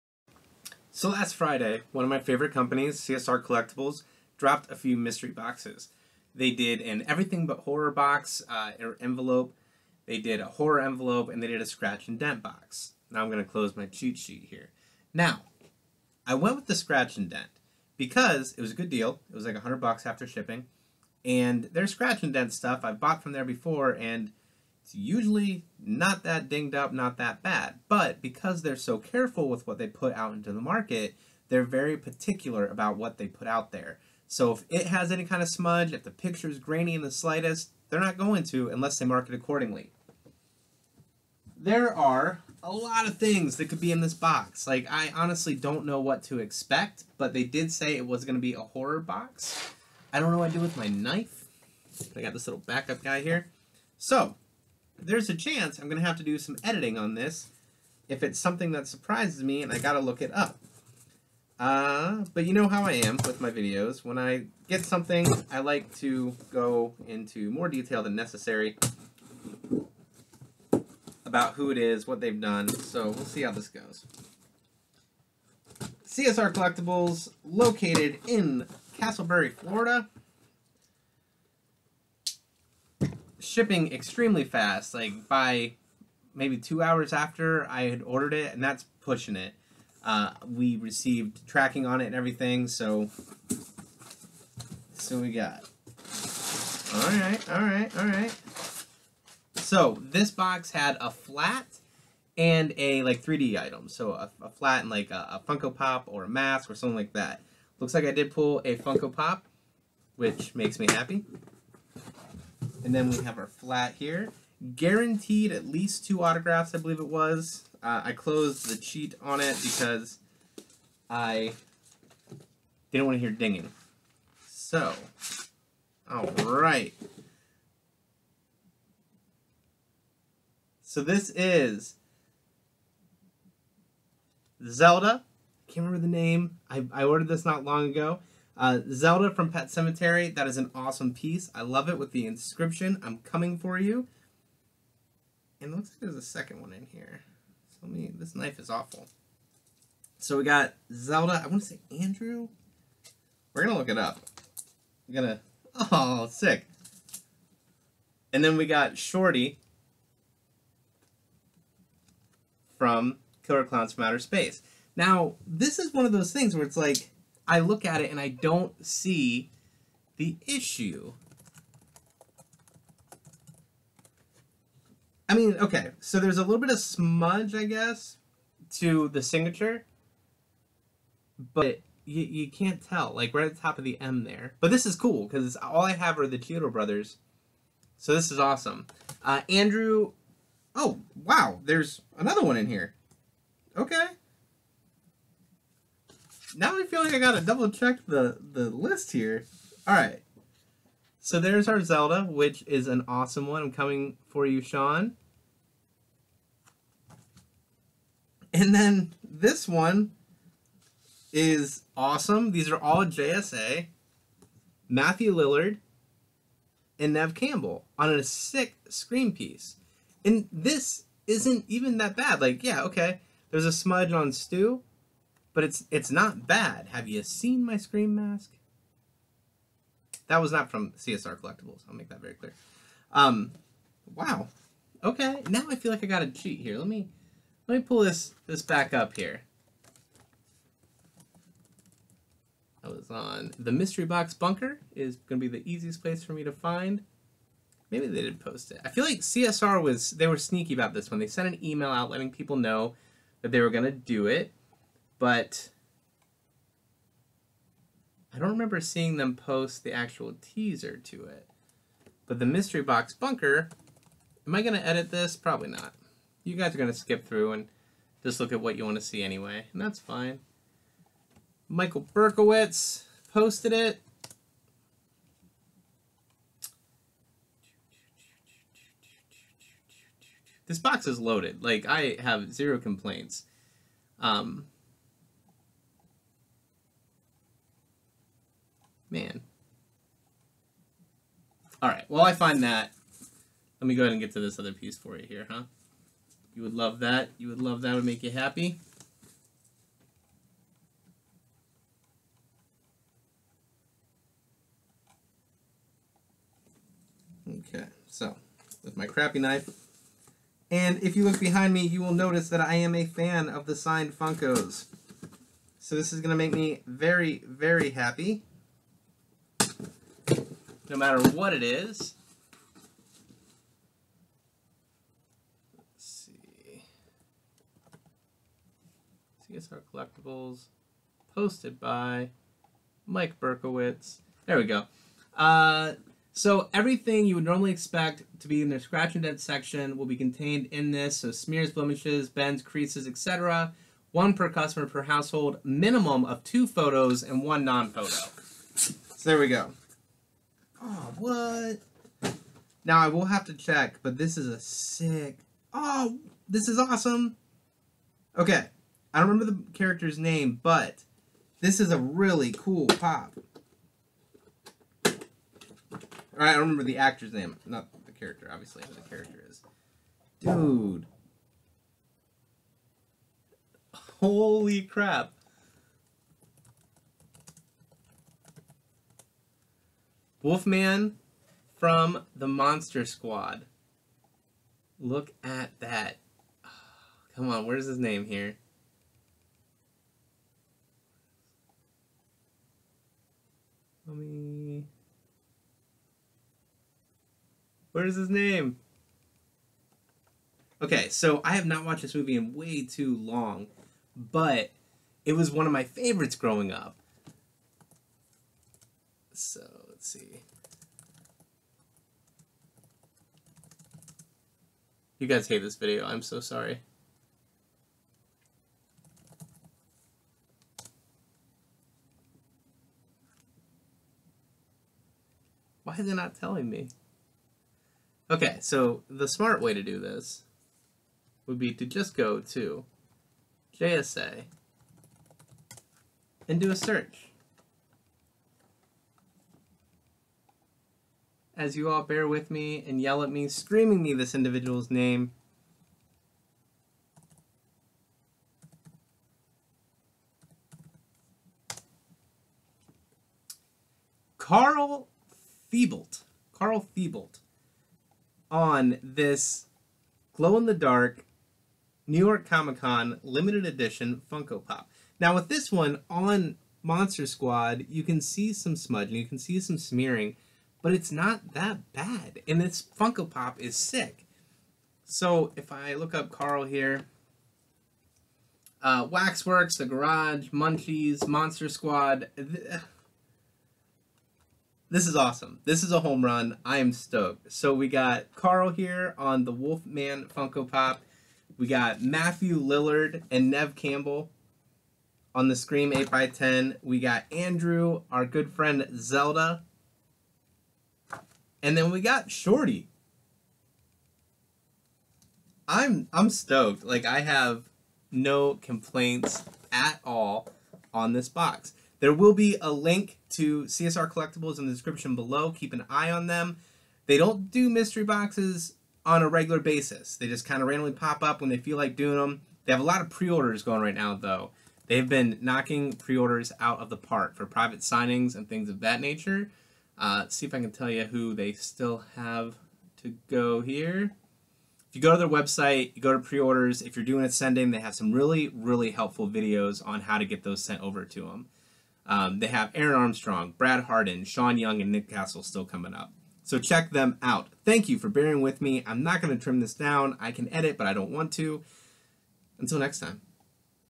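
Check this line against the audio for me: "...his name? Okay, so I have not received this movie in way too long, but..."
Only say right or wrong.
wrong.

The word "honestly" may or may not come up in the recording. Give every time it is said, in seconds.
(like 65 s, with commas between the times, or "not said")
45 s.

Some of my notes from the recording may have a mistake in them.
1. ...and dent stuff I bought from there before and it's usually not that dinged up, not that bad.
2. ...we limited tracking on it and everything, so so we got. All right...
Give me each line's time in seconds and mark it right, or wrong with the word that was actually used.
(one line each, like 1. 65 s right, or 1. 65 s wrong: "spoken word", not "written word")
1. 22 s right
2. 90 s wrong: "received", not "limited".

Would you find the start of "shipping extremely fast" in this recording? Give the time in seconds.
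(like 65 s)
83 s.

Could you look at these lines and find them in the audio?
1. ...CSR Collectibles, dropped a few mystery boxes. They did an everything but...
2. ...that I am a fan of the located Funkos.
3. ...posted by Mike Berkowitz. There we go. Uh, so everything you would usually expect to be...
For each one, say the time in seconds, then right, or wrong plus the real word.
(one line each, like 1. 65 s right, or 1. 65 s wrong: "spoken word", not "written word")
1. 3 s right
2. 312 s wrong: "signed", not "located"
3. 331 s wrong: "normally", not "usually".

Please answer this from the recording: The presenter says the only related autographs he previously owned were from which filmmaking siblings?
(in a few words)
Chiodo Brothers.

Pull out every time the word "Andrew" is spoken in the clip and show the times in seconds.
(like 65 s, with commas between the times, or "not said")
151 s, 189 s, 497 s.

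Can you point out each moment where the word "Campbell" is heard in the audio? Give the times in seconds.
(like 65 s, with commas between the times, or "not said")
217 s, 493 s.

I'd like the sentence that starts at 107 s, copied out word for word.
Looks like I did pull a Funko Pop, which makes me happy.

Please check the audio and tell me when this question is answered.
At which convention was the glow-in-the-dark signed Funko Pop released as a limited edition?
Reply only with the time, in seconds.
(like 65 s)
462 s.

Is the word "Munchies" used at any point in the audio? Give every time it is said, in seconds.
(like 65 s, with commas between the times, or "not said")
480 s.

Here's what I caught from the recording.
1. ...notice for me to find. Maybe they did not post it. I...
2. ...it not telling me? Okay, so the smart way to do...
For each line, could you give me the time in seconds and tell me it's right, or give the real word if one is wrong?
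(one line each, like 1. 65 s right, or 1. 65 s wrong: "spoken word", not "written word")
1. 246 s wrong: "place", not "notice"
2. 426 s right.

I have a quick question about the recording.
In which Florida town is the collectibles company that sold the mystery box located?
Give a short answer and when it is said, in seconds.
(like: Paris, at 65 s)
Casselberry, at 78 s.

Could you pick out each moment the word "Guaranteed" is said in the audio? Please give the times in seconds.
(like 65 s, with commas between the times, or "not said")
114 s.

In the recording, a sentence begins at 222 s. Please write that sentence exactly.
Like, yeah, okay, there's a smudge on Stu, but it's it's not bad.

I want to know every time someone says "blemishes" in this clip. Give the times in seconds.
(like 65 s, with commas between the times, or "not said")
341 s.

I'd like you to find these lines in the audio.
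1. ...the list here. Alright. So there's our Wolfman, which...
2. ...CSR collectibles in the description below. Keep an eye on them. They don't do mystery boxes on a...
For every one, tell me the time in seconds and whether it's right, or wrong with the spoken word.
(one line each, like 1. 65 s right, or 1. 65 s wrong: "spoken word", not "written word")
1. 198 s wrong: "Zelda", not "Wolfman"
2. 513 s right.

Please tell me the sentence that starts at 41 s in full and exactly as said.
There are a lot of things that could be in this box.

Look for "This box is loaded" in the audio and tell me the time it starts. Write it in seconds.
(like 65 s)
280 s.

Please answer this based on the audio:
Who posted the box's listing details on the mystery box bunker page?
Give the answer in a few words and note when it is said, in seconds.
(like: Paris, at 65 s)
Michael Berkowitz, at 271 s.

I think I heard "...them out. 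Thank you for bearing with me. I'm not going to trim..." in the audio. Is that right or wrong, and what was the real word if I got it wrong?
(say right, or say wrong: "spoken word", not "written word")
right.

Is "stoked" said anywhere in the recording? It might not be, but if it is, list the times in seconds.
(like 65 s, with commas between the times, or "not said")
486 s, 506 s.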